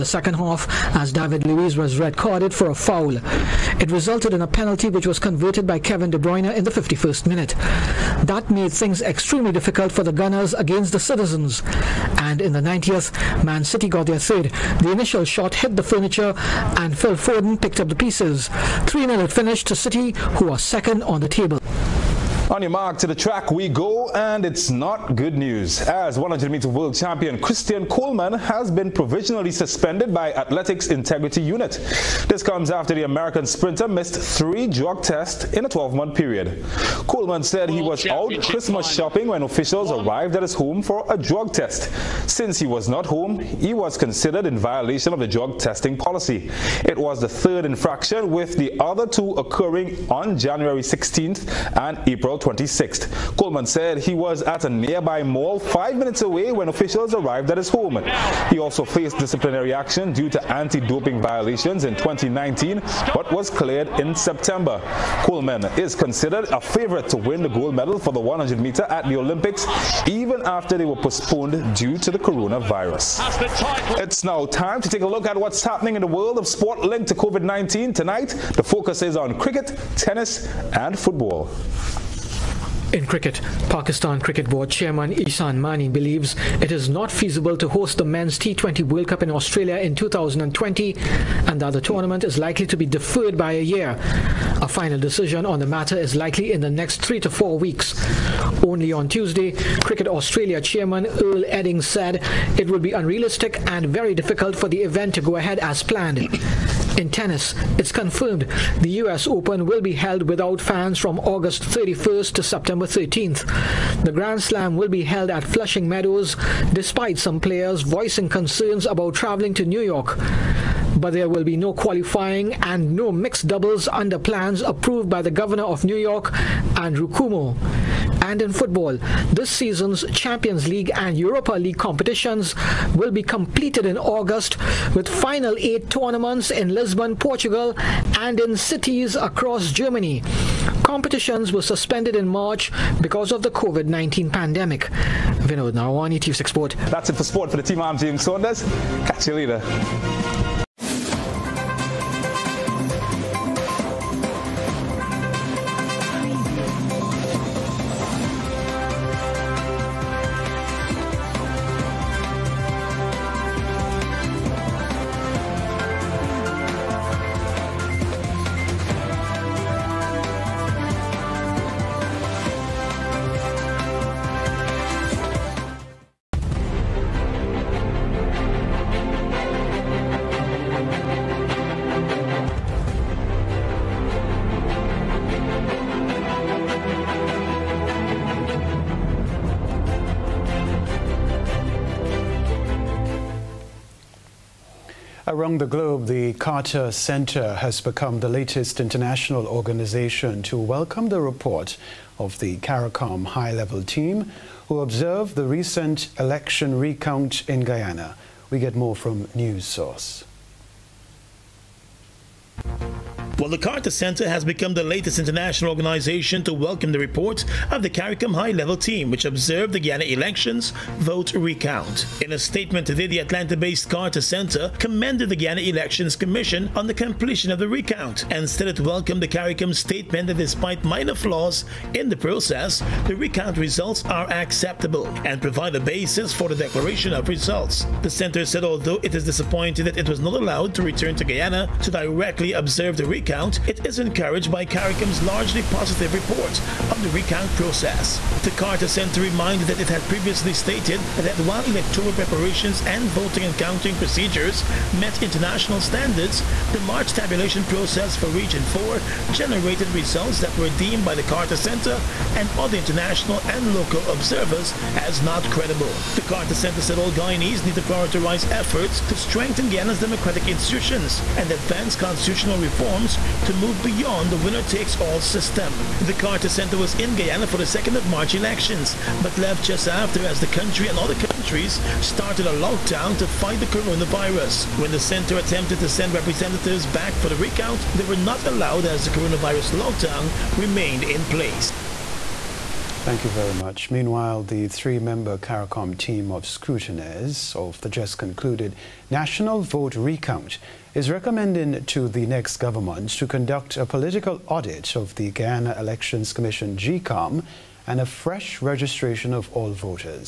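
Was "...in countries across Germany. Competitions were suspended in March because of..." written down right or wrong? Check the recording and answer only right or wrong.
wrong.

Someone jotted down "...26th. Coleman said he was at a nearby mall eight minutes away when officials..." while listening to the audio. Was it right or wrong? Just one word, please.
wrong.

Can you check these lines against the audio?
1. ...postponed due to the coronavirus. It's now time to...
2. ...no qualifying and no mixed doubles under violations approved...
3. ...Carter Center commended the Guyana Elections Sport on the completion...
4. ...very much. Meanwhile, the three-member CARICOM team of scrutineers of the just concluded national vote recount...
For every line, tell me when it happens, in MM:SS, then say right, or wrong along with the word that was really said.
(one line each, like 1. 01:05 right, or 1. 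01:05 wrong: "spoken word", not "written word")
1. 01:10 right
2. 02:01 wrong: "plans", not "violations"
3. 03:43 wrong: "Commission", not "Sport"
4. 04:53 right.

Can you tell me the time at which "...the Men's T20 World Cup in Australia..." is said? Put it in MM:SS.
01:27.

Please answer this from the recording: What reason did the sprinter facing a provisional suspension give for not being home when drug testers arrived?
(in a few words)
Christmas shopping.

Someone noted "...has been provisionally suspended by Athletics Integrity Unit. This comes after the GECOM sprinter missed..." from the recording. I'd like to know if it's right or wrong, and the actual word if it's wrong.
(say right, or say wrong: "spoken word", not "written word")
wrong: "American", not "GECOM".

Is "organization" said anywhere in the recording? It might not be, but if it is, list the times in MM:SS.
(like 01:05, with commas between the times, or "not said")
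03:19, 03:35.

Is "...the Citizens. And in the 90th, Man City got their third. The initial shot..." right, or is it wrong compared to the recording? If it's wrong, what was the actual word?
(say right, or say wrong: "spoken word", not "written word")
right.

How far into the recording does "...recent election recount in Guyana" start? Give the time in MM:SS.
03:25.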